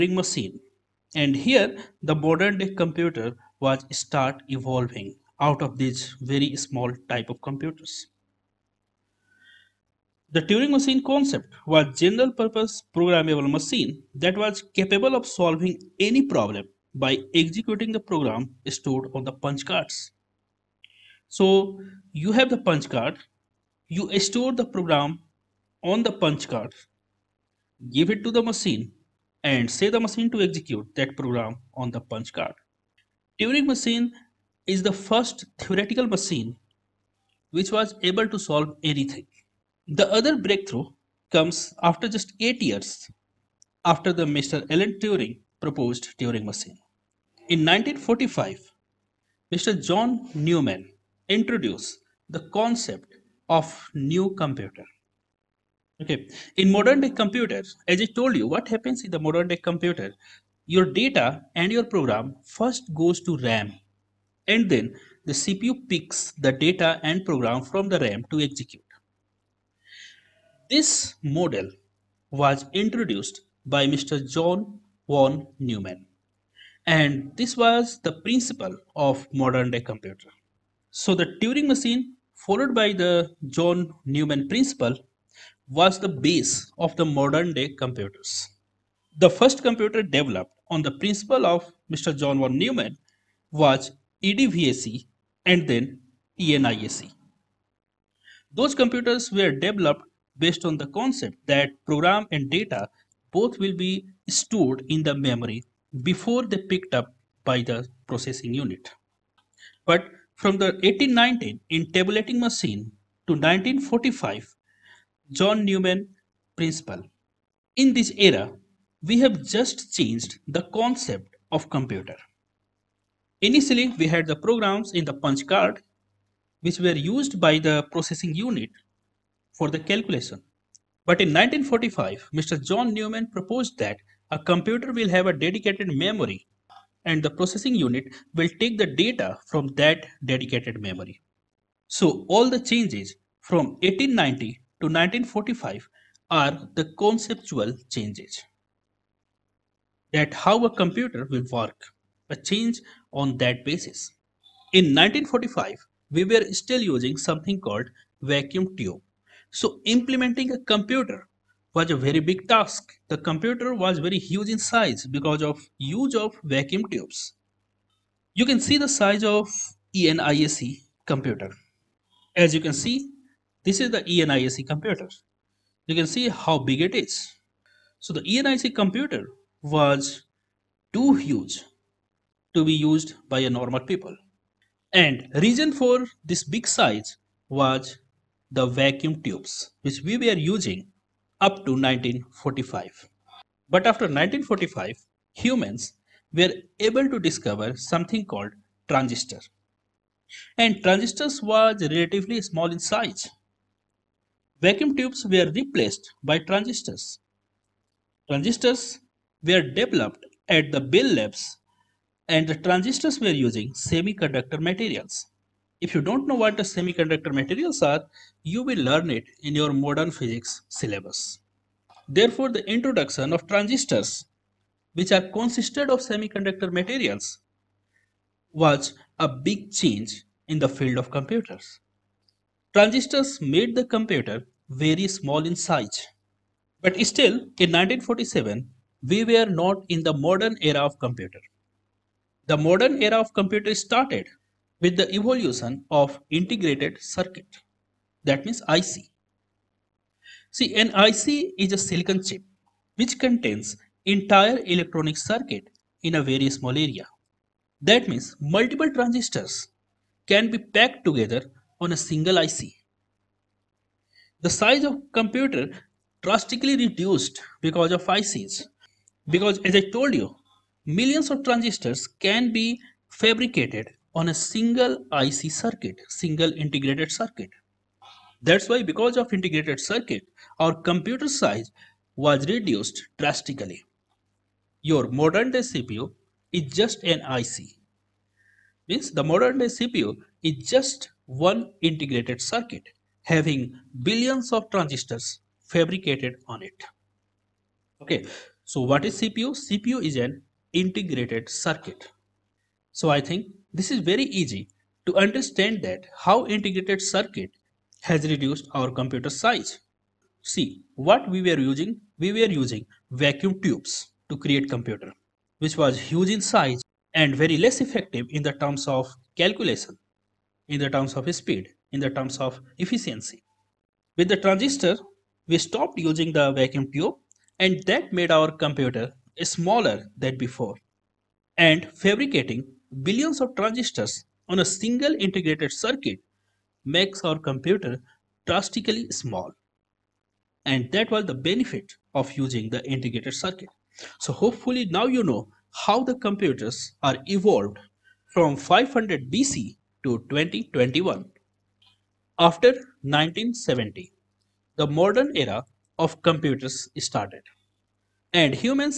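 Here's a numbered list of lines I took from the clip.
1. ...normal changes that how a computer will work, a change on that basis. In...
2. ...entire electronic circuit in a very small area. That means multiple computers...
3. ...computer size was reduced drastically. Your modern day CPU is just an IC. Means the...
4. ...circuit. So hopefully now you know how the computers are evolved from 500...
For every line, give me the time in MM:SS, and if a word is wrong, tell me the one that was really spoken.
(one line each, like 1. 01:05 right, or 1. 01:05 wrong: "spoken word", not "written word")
1. 02:26 wrong: "conceptual", not "normal"
2. 04:14 wrong: "transistors", not "computers"
3. 04:40 right
4. 05:43 right.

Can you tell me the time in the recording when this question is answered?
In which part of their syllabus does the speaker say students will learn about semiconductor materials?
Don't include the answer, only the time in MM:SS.
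03:39.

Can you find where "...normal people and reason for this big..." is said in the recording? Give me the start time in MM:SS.
03:03.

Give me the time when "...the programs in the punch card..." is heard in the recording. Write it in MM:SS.
02:04.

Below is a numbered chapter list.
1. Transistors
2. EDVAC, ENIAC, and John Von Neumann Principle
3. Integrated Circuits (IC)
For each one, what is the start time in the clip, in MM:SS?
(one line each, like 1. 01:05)
1. 03:13
2. 00:46
3. 04:01.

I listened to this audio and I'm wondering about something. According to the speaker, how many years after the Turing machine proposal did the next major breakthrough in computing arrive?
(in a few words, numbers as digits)
8 years.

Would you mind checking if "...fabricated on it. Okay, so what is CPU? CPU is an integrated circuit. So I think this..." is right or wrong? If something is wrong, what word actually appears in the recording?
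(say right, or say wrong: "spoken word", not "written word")
right.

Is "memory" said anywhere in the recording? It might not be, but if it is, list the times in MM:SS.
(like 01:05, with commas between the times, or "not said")
01:45, 02:15, 02:20.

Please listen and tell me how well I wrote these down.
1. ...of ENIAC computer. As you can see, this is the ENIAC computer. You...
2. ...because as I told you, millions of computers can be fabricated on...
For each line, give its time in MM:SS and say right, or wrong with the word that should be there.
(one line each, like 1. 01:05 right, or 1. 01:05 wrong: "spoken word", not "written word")
1. 02:49 right
2. 04:29 wrong: "transistors", not "computers".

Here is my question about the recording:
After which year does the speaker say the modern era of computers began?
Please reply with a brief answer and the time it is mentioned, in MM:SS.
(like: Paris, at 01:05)
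1970, at 05:52.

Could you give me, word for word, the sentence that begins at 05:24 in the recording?
With the transistor, we stopped using the vacuum tube and that made our computer smaller than before.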